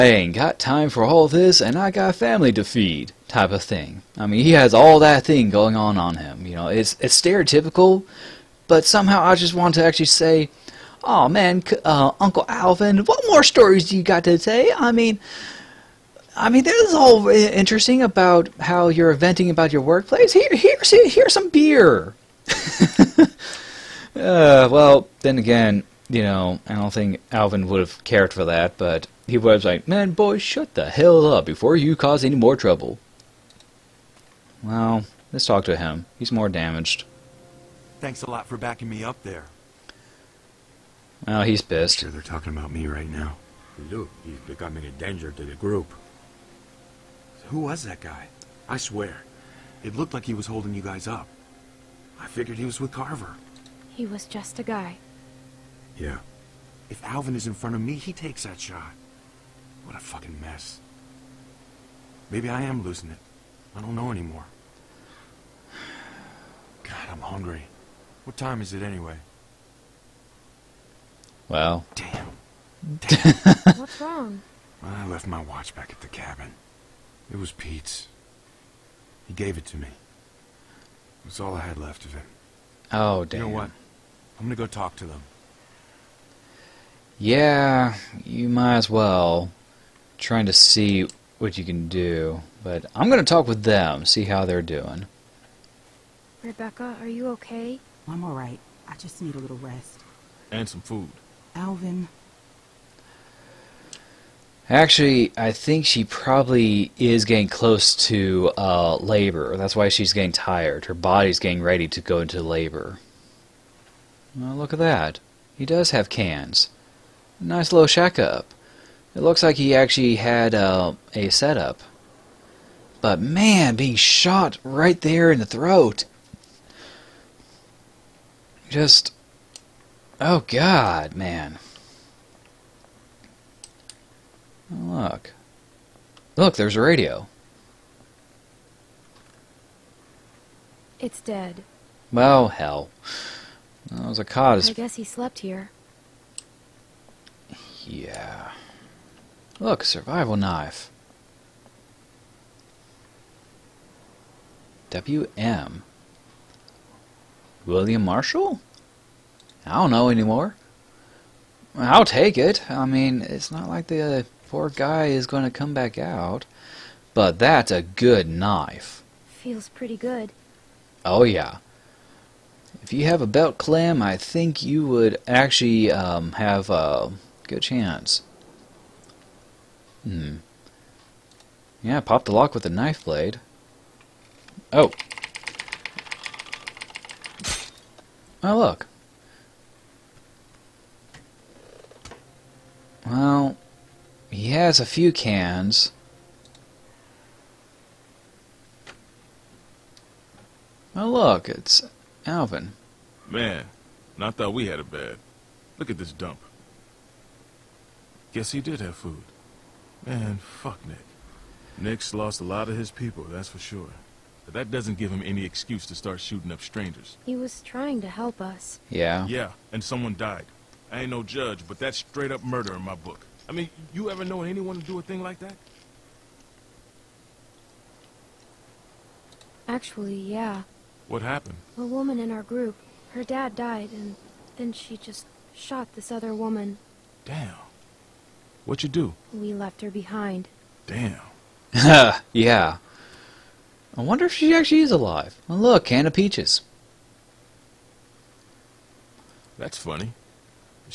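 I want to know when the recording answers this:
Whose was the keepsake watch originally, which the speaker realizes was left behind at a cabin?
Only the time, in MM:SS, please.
01:17.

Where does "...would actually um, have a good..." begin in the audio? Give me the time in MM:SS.
02:54.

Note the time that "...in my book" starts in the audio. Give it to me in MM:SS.
03:42.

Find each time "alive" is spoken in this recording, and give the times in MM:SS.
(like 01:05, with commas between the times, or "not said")
04:04.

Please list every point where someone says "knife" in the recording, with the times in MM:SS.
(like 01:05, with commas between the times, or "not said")
02:30, 02:48, 03:02.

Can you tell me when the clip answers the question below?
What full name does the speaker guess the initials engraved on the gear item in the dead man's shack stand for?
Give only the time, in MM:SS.
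02:37.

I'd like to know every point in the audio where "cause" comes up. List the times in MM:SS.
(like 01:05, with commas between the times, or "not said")
00:31, 02:24.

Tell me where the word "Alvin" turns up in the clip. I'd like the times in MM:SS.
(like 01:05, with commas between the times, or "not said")
00:12, 00:27, 00:57, 01:41, 03:22.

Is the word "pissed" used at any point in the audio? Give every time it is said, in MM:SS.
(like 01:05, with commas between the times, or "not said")
00:41.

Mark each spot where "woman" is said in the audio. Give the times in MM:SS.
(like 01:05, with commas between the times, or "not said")
03:51, 03:56.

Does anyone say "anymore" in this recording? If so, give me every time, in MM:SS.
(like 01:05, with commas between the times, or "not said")
01:04, 02:40.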